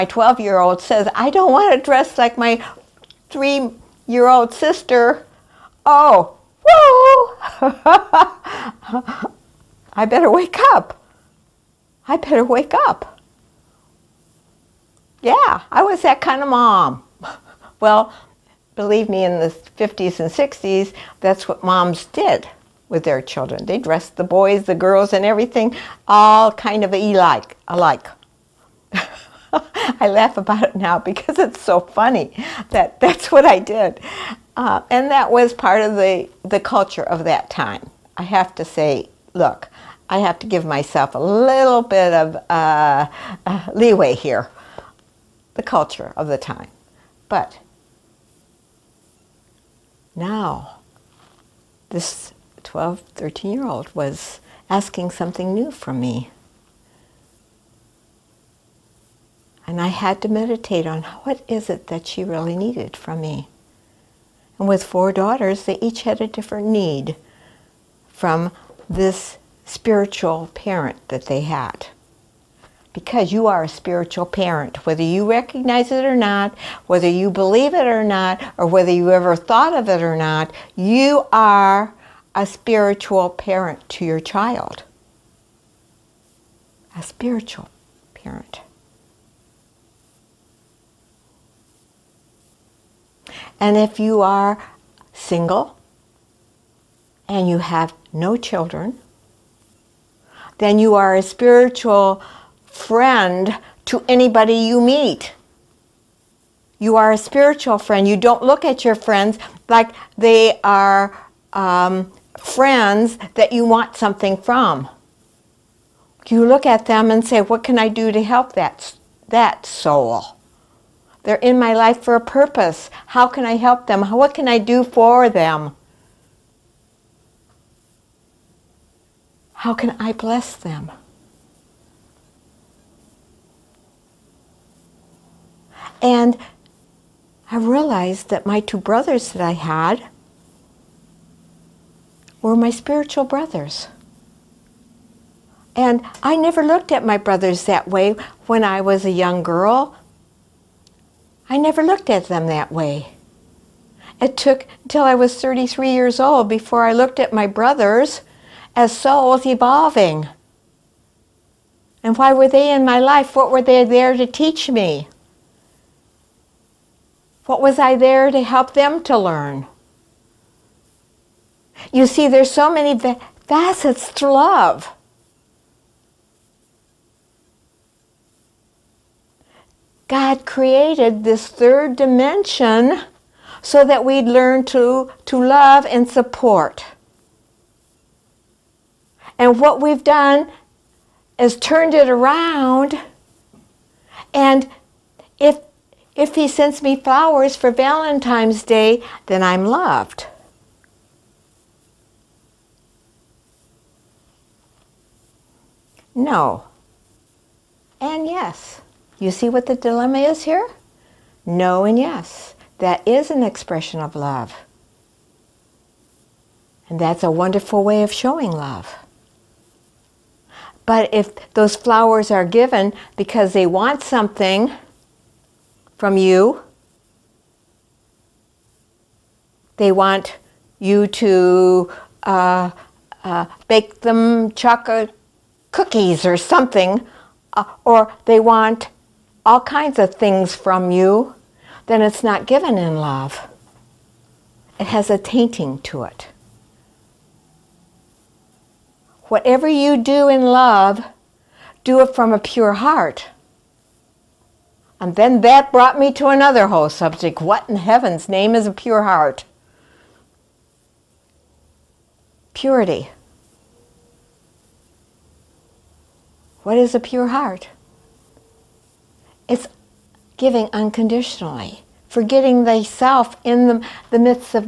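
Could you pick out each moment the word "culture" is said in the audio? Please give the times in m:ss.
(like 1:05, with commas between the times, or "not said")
0:36, 0:45.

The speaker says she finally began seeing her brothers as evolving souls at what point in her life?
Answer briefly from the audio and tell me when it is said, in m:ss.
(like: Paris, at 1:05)
33 years old, at 2:35.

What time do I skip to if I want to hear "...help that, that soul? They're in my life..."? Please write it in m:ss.
1:58.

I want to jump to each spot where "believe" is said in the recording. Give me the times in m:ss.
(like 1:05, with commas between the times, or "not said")
0:18, 1:17.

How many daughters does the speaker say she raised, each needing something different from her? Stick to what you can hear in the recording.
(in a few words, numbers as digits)
4.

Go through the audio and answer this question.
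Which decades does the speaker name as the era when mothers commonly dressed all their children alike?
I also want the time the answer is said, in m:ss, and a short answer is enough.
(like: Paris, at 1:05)
the 50s and 60s, at 0:19.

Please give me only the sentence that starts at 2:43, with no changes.
What were they there to teach me?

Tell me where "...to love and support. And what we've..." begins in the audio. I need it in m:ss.
3:05.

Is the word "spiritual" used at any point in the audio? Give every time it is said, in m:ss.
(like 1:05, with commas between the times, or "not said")
1:09, 1:13, 1:22, 1:27, 1:41, 1:47, 2:22.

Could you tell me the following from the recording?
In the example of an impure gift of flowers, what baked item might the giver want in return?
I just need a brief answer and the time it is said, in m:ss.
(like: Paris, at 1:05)
chocolate cookies, at 3:54.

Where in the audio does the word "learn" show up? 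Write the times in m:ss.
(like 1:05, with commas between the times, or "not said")
2:49, 3:04.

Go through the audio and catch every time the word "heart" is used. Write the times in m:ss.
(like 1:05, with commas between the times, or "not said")
4:12, 4:19, 4:27.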